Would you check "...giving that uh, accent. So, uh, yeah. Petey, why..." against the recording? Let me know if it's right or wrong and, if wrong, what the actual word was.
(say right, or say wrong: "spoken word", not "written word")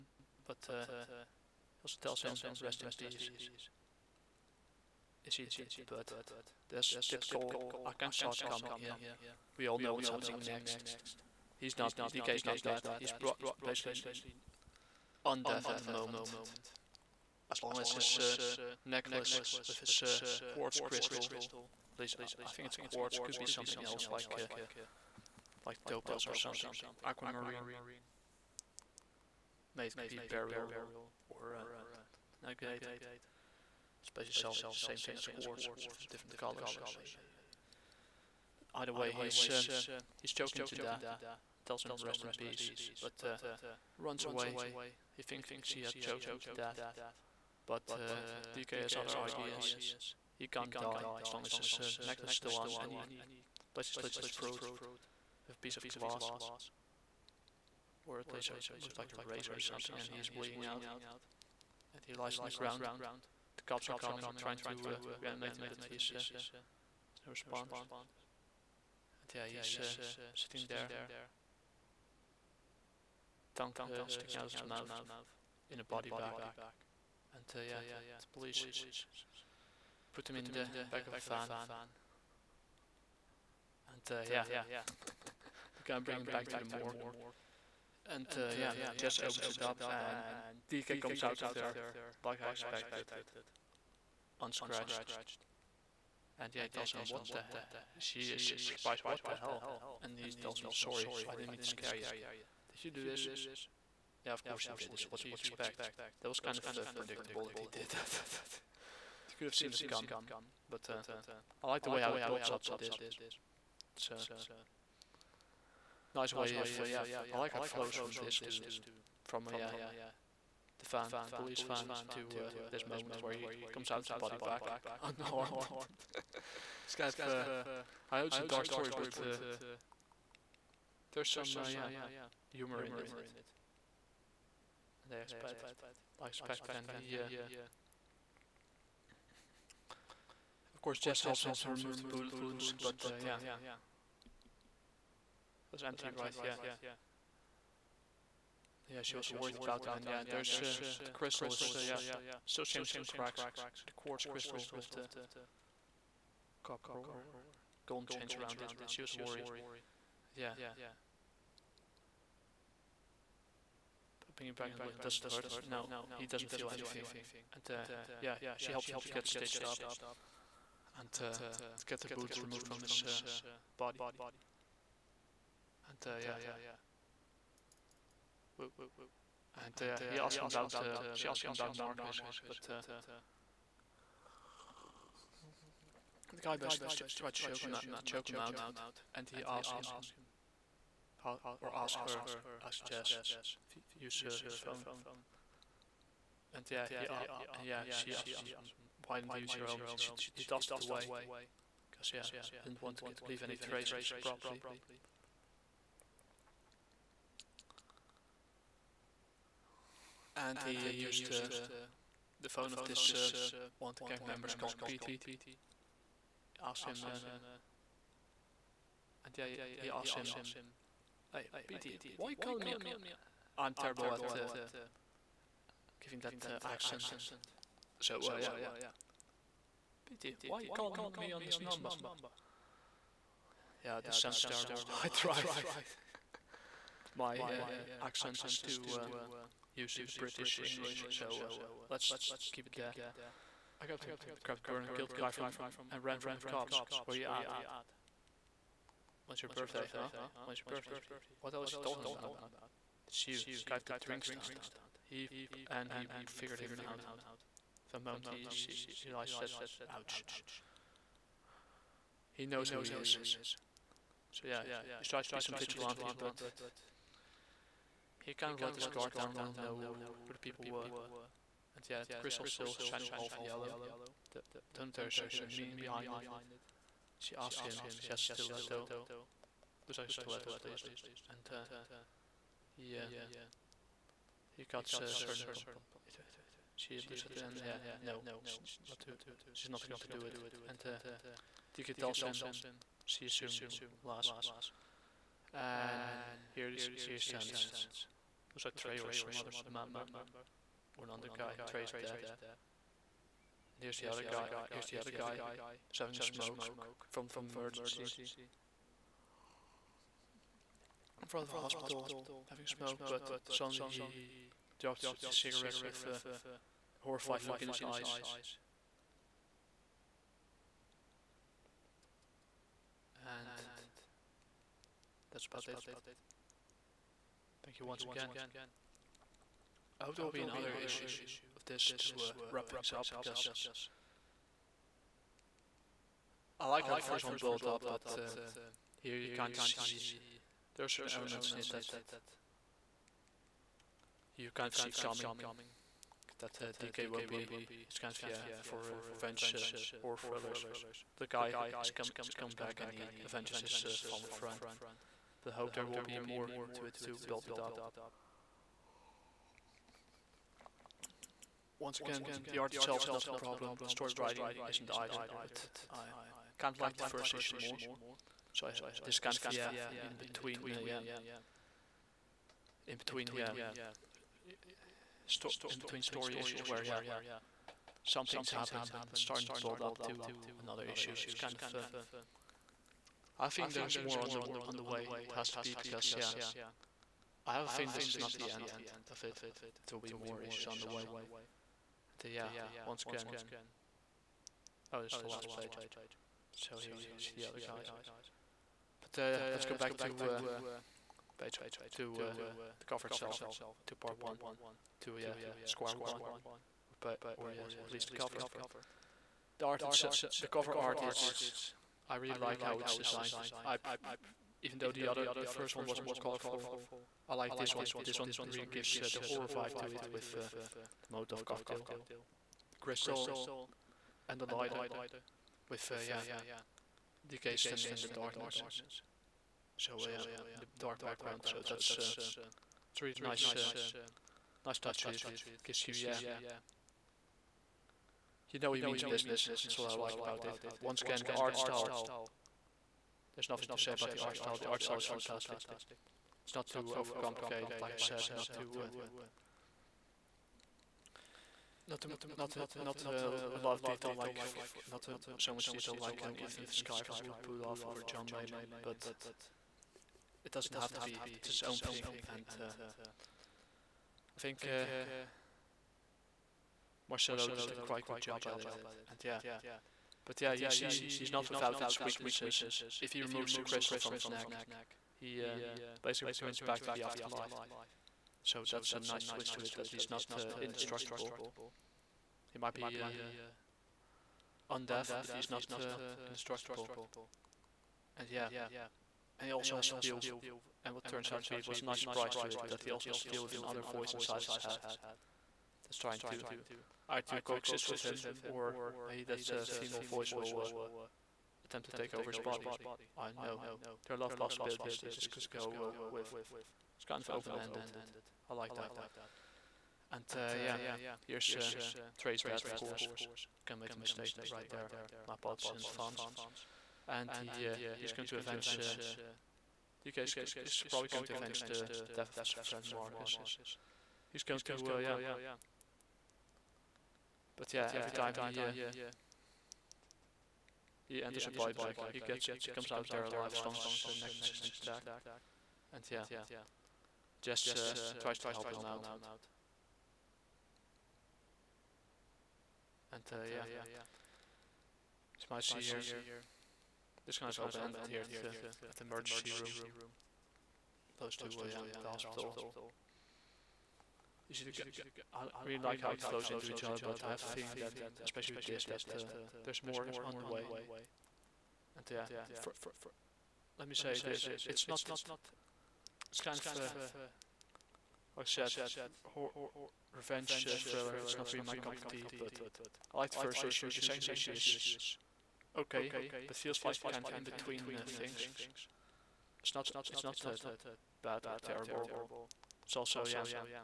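right.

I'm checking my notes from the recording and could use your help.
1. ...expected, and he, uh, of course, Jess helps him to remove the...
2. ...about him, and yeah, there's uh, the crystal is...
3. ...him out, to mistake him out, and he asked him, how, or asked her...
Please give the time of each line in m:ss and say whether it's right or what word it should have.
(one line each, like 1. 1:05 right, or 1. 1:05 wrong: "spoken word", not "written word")
1. 2:16 right
2. 2:29 right
3. 3:07 wrong: "choke", not "mistake".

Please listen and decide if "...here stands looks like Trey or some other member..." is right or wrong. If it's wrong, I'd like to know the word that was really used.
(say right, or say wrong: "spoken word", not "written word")
right.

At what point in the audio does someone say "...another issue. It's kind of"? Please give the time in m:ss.
6:20.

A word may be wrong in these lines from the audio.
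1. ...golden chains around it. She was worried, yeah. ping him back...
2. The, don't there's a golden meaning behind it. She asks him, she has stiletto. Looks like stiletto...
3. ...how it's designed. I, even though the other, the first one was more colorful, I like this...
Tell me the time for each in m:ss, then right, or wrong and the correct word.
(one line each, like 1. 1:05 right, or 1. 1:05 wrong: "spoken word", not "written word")
1. 2:37 right
2. 4:34 wrong: "hidden", not "golden"
3. 6:52 right.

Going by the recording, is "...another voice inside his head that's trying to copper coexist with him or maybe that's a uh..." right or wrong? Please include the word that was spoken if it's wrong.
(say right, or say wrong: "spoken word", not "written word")
wrong: "either", not "copper".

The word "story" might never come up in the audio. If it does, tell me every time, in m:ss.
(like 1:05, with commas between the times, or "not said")
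2:08, 6:03, 6:16.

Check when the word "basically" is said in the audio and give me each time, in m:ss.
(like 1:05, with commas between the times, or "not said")
0:13, 0:34, 0:53, 3:06, 7:56.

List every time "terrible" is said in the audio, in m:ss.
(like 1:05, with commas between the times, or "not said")
3:43, 3:54, 9:41.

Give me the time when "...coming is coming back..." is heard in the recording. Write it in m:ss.
5:51.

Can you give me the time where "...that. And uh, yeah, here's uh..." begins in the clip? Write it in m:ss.
8:28.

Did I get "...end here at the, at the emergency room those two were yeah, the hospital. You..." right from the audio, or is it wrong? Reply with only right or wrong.
right.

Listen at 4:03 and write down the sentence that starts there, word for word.
I grabbed the, grabbed the burner, killed the guy from, and ran from the cops.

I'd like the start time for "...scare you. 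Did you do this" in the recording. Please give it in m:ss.
1:41.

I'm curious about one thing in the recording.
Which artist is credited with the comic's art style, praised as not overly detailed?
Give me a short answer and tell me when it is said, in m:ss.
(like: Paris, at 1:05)
Marcelo, at 7:47.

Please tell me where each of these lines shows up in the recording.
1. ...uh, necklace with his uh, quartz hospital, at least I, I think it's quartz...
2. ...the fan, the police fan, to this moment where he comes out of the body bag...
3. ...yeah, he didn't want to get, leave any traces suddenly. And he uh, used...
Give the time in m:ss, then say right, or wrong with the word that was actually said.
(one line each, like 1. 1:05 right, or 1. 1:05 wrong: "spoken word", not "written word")
1. 0:18 wrong: "crystal", not "hospital"
2. 2:00 right
3. 3:22 wrong: "properly", not "suddenly".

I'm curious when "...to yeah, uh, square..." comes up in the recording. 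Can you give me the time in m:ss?
6:45.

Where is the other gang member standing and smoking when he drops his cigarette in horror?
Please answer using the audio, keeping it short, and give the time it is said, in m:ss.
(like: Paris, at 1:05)
in front of a hospital, at 5:11.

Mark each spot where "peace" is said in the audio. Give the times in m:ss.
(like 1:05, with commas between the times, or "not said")
0:02, 0:42.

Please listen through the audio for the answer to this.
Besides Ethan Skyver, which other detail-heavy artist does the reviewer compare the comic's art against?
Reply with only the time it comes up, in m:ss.
7:38.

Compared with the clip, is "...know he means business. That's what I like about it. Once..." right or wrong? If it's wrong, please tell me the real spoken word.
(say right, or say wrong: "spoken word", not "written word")
right.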